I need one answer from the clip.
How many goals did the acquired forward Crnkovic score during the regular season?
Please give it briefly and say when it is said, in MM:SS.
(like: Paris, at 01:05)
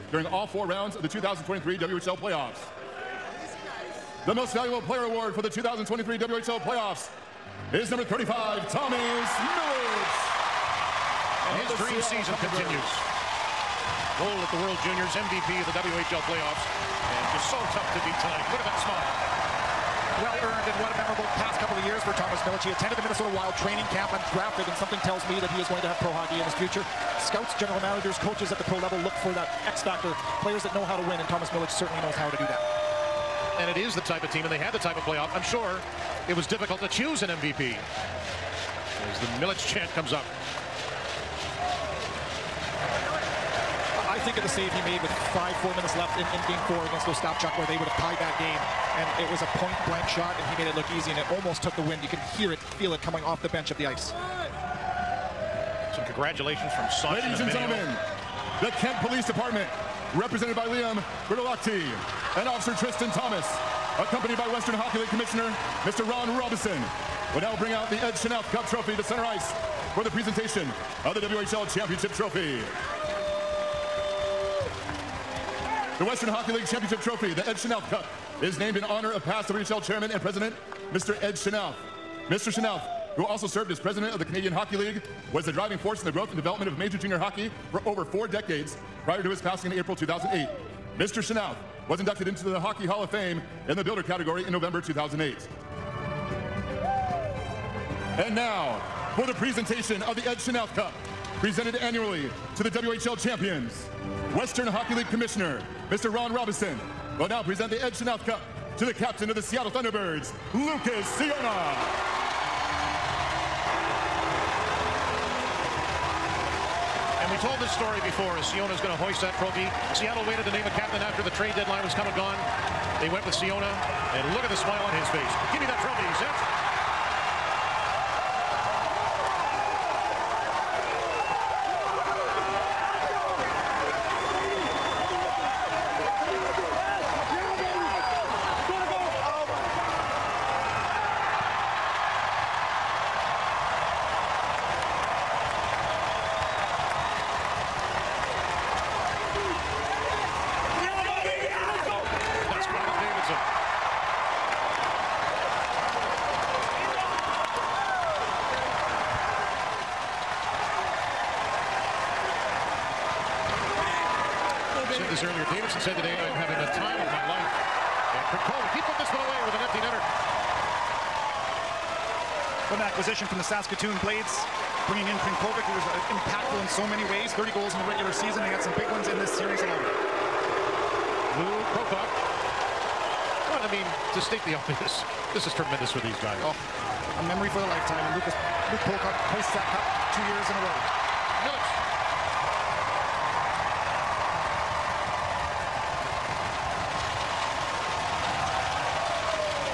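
30, at 02:57.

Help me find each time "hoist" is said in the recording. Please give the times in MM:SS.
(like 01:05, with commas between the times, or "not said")
01:58, 03:09.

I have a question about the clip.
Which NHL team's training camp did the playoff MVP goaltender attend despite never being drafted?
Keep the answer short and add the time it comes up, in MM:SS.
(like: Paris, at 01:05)
Minnesota Wild, at 00:23.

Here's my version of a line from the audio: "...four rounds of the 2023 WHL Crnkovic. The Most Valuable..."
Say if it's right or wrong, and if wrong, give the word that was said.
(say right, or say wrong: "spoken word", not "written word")
wrong: "Playoffs", not "Crnkovic".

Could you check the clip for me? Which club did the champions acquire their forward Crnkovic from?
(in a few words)
Saskatoon Blades.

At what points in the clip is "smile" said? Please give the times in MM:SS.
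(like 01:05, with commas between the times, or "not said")
00:18, 02:04.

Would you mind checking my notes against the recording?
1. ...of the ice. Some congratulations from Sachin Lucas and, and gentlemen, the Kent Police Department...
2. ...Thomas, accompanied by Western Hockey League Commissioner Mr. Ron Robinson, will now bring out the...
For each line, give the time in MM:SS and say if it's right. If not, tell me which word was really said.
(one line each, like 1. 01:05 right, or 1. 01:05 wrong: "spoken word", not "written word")
1. 00:53 wrong: "Ladies", not "Lucas"
2. 01:03 right.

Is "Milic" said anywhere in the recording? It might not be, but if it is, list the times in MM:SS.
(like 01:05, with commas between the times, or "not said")
00:08, 00:22, 00:31, 00:39, 03:11.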